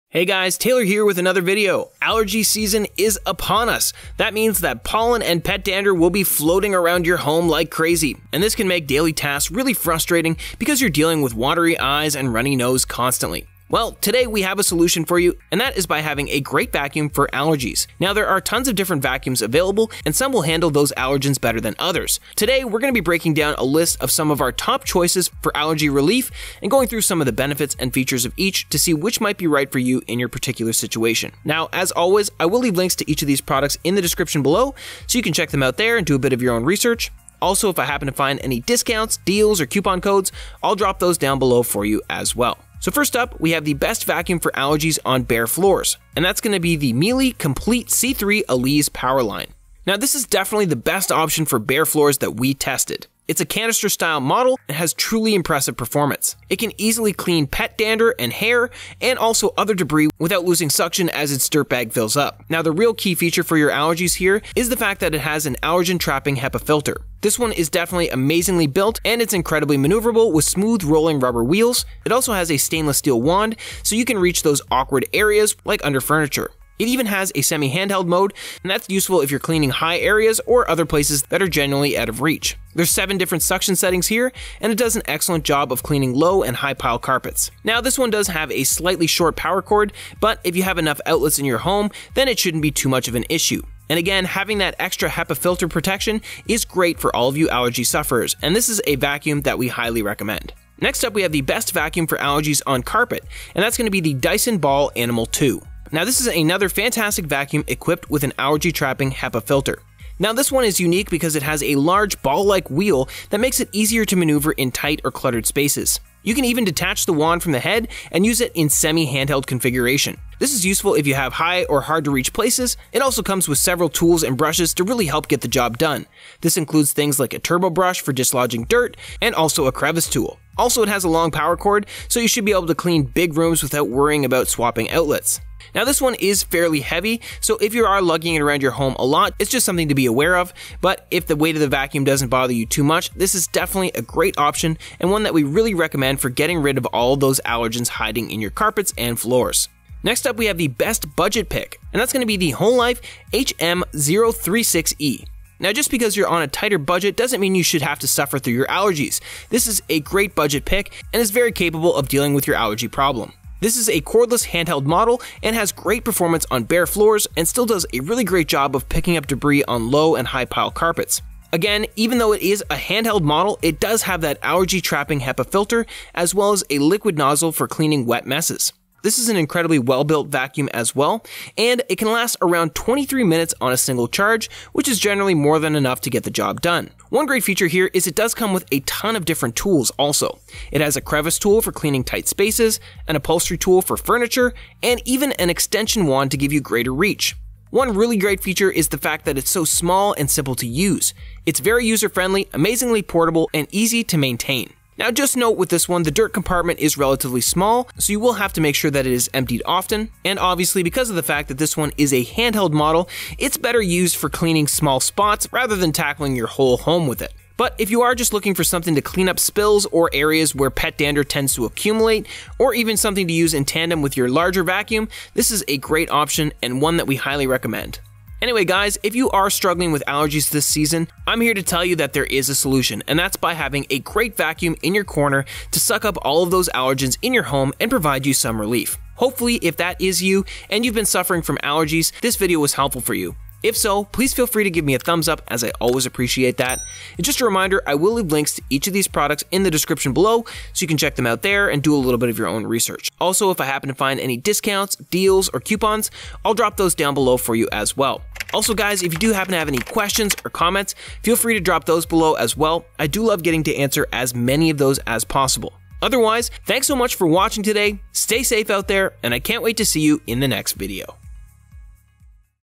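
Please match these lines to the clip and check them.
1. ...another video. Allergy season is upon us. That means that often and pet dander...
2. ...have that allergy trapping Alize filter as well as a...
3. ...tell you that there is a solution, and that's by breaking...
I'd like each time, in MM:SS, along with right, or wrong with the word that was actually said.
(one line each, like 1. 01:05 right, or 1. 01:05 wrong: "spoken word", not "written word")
1. 00:01 wrong: "pollen", not "often"
2. 02:54 wrong: "HEPA", not "Alize"
3. 03:51 wrong: "having", not "breaking".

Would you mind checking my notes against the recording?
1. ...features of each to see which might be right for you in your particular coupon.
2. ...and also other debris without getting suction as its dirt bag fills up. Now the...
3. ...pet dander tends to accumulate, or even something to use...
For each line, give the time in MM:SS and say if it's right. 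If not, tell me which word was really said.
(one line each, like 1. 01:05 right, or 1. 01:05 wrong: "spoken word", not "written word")
1. 00:27 wrong: "situation", not "coupon"
2. 00:58 wrong: "losing", not "getting"
3. 03:40 right.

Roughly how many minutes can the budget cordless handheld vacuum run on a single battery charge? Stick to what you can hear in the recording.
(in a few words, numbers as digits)
23.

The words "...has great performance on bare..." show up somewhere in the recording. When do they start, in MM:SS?
02:45.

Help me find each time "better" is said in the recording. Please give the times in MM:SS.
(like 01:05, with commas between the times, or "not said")
00:21, 03:33.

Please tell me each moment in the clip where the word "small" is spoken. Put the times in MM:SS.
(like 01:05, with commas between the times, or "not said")
03:19, 03:27, 03:34.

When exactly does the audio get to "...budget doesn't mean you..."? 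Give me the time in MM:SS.
02:36.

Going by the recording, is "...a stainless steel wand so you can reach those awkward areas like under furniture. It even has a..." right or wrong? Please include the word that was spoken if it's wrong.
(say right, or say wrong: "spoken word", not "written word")
right.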